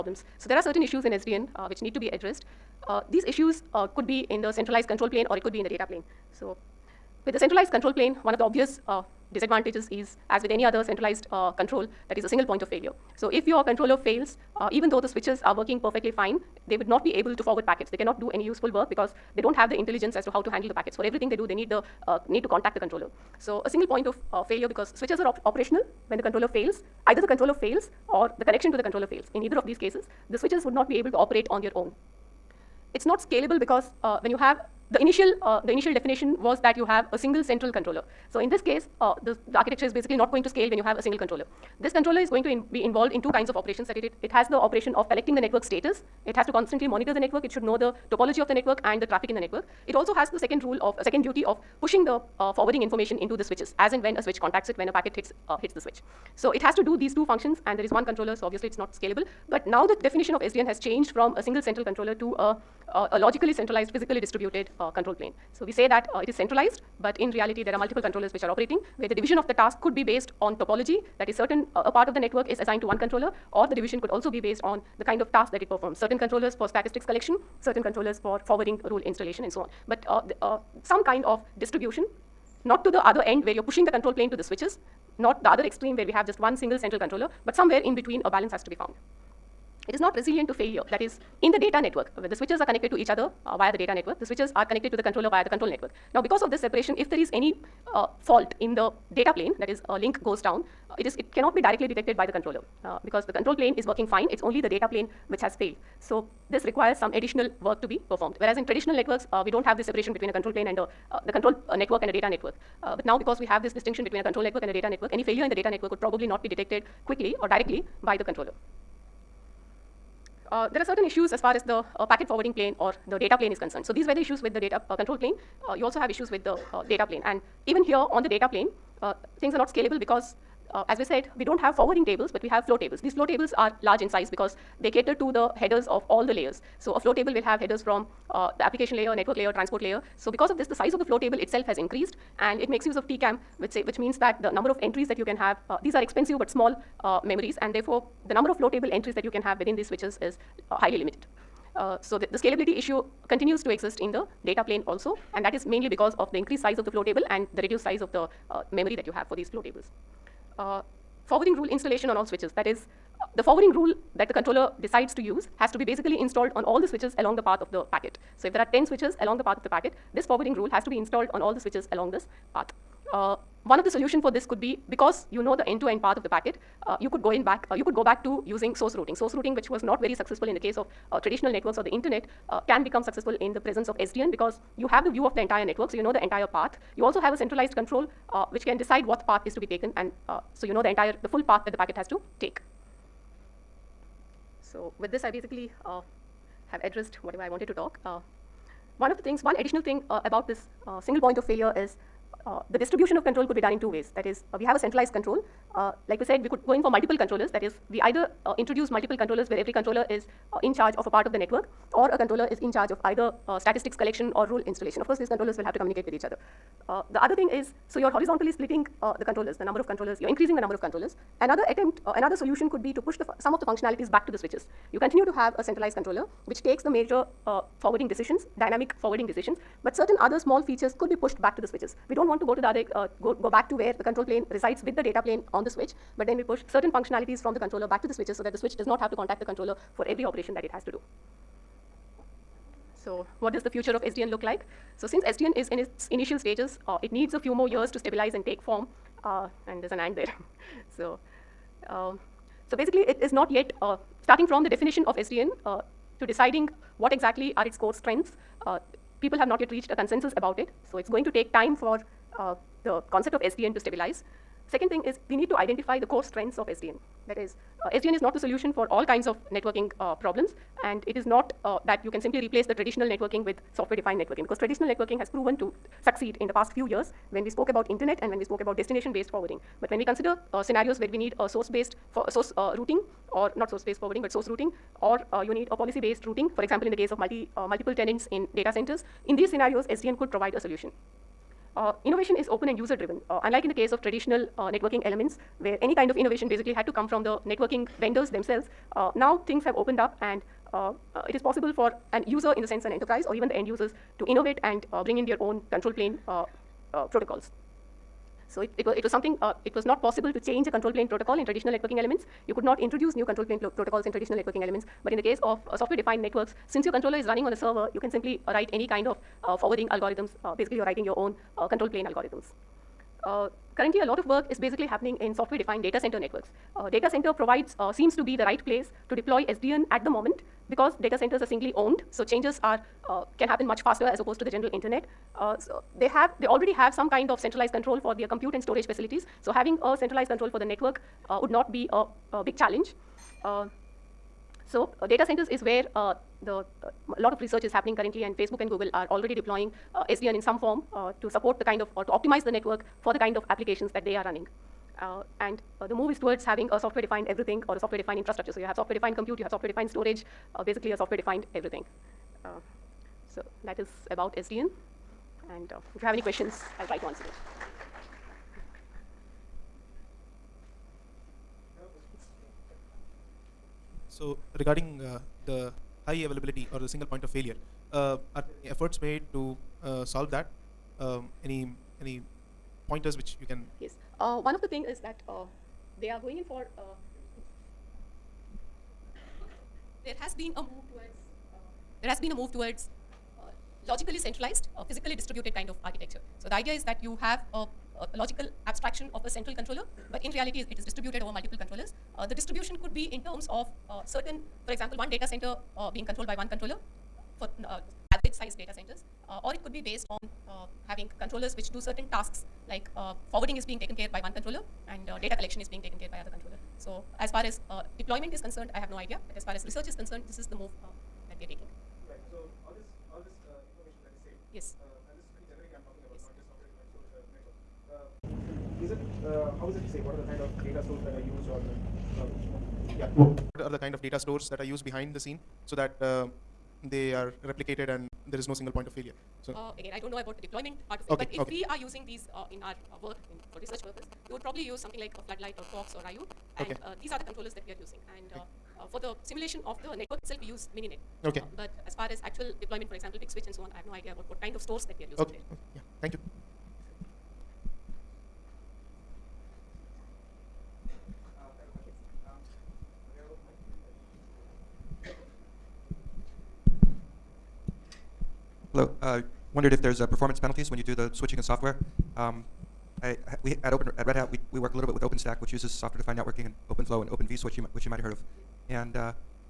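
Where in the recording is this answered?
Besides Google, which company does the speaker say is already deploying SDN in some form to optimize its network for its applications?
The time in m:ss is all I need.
5:48.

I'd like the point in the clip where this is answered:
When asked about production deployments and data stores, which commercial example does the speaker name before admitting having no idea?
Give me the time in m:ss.
7:33.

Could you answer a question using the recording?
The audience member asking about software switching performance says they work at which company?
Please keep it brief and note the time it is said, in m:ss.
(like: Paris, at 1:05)
Red Hat, at 7:54.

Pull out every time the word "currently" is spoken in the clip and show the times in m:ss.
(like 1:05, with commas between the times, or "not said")
5:23, 5:47.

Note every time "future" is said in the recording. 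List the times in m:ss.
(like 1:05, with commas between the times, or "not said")
4:03.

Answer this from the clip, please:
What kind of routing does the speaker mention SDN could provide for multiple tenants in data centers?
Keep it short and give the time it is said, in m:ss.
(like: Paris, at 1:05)
Policy-based routing, at 4:45.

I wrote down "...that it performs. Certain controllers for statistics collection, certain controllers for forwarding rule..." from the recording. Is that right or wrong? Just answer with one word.
right.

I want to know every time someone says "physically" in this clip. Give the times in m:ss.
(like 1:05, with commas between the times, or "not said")
1:03, 6:34.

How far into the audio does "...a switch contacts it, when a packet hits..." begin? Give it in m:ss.
0:54.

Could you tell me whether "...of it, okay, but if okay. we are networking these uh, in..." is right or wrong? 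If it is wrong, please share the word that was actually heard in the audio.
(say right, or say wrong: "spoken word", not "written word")
wrong: "using", not "networking".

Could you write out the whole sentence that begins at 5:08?
So it, it, was, it was something, uh, it was not possible to change a control plane protocol in traditional networking elements.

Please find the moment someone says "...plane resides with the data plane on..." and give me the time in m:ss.
3:54.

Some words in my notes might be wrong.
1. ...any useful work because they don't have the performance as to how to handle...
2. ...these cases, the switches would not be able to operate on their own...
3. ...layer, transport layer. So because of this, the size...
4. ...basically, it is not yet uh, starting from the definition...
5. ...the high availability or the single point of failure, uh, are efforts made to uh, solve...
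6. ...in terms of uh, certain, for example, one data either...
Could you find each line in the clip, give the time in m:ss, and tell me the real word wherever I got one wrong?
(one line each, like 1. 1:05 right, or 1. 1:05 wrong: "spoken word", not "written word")
1. 0:18 wrong: "intelligence", not "performance"
2. 0:29 right
3. 2:19 right
4. 4:12 right
5. 6:15 right
6. 6:43 wrong: "center", not "either".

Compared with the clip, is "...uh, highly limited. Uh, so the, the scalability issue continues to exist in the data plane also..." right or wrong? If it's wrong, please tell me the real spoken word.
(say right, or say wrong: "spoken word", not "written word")
right.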